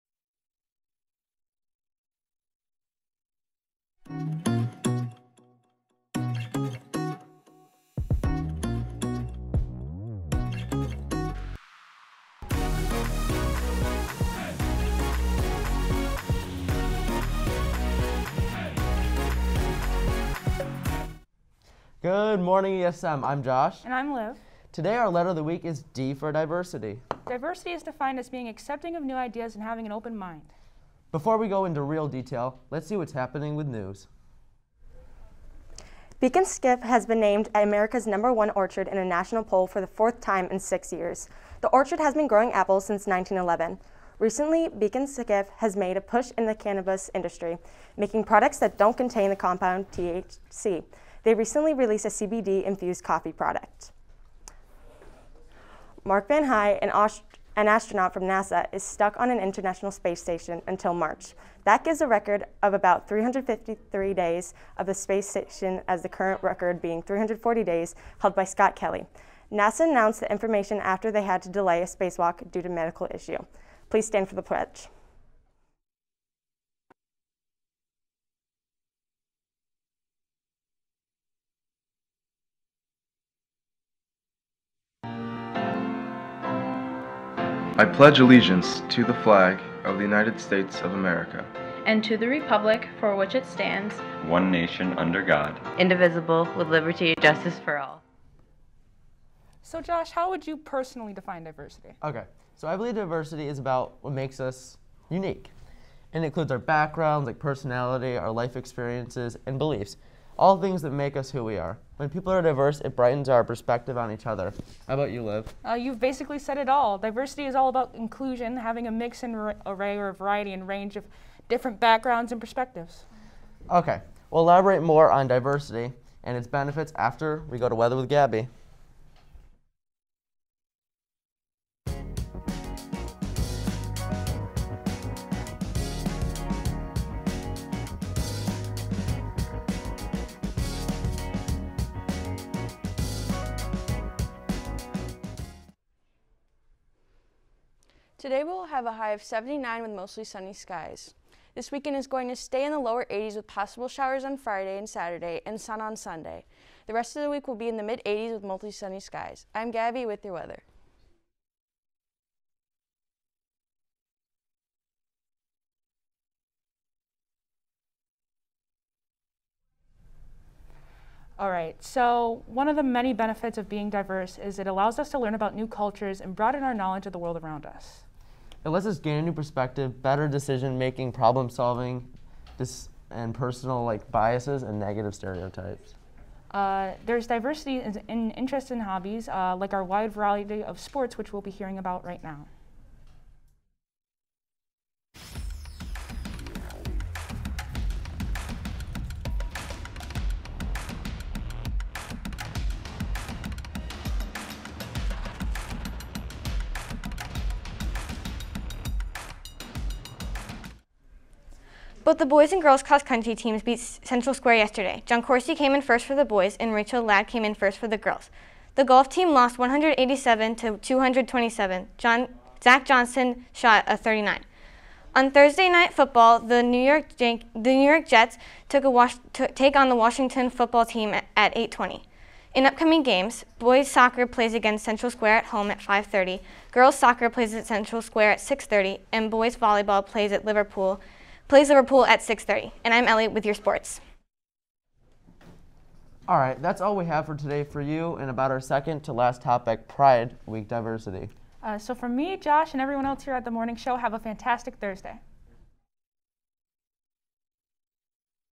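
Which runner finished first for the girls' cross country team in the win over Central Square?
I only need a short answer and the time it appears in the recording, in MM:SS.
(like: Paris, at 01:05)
Rachel Ladd, at 03:36.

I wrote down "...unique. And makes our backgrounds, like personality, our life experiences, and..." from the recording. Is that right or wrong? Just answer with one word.
wrong.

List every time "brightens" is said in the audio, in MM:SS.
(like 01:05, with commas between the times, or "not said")
01:52.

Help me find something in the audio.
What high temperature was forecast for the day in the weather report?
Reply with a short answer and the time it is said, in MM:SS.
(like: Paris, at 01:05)
79, at 02:29.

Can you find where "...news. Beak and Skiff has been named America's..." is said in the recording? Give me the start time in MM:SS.
00:33.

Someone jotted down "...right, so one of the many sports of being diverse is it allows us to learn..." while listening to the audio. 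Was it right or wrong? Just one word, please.
wrong.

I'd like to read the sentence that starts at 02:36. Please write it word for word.
The rest of the week will be in the mid 80s with mostly sunny skies.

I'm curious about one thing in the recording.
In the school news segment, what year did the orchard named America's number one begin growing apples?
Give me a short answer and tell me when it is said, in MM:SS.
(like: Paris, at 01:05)
1911, at 00:43.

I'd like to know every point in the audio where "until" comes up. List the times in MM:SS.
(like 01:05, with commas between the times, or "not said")
01:00.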